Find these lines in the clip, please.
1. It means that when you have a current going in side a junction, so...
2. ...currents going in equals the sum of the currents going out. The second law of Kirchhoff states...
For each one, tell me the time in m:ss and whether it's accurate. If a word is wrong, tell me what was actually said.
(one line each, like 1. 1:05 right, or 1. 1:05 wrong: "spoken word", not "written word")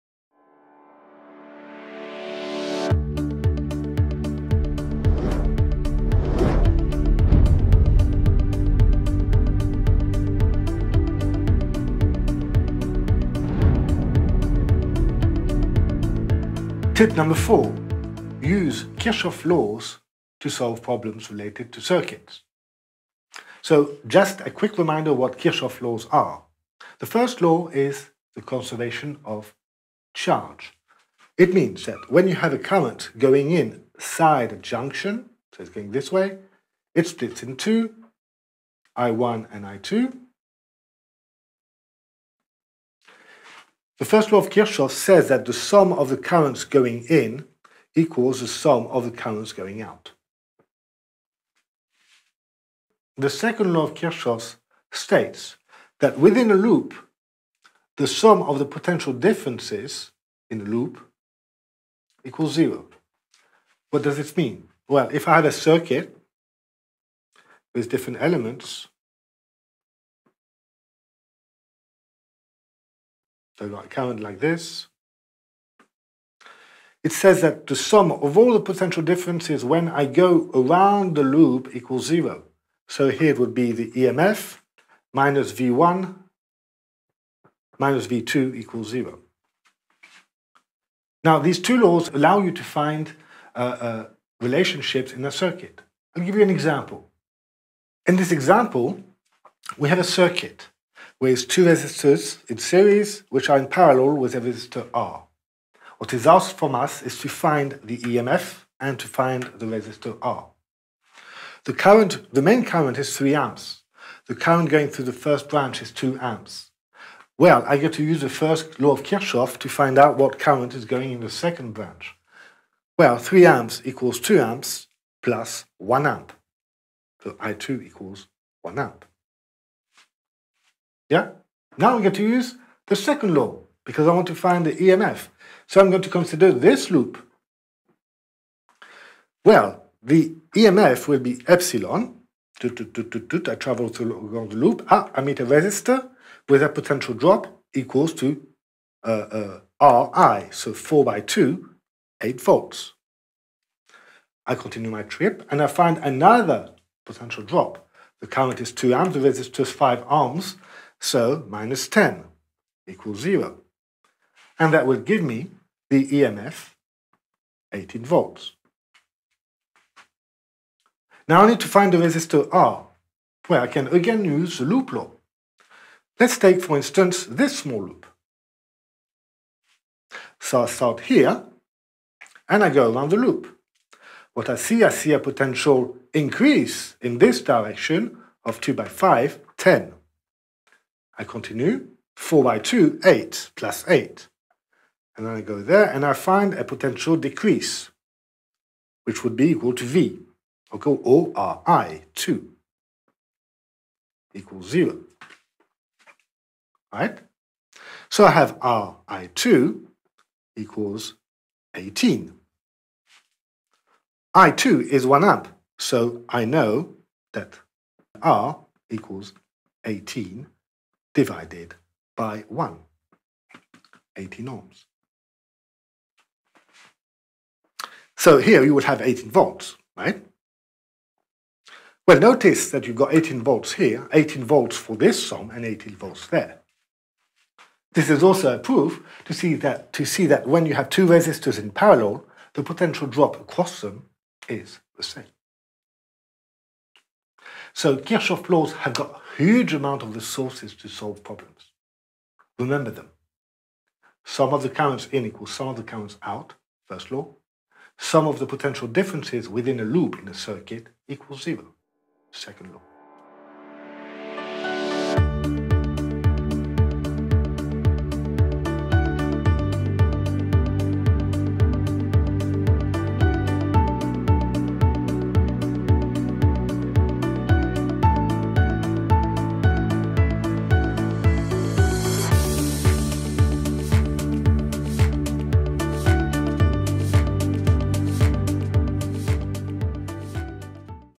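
1. 0:31 right
2. 0:46 right.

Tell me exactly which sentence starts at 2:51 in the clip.
Now I need to find the resistor R, where I can again use the loop law.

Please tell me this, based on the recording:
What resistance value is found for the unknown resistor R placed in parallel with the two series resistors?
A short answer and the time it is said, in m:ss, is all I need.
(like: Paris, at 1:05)
18 ohms, at 3:44.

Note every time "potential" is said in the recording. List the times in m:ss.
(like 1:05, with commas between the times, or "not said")
0:58, 1:18, 2:26, 2:37, 3:05, 3:16, 4:02, 4:18.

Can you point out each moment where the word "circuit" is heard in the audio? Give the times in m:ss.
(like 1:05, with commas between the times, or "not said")
0:21, 1:05, 1:35, 1:40, 4:20.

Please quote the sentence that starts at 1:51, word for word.
The current, the main current is 3 amps.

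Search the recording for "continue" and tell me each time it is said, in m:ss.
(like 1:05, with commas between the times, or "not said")
2:34, 3:11.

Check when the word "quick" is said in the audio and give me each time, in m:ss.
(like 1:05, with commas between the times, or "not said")
0:24.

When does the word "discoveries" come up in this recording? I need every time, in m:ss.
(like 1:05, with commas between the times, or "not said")
not said.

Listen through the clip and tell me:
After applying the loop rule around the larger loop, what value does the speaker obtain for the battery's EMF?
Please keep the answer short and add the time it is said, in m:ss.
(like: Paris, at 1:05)
18 volts, at 2:46.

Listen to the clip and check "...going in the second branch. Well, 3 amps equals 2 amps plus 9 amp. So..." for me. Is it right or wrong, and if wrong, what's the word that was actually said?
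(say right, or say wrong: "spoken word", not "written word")
wrong: "1", not "9".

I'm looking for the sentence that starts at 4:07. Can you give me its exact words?
So Kirchhoff laws have got huge amount of resources to solve problems.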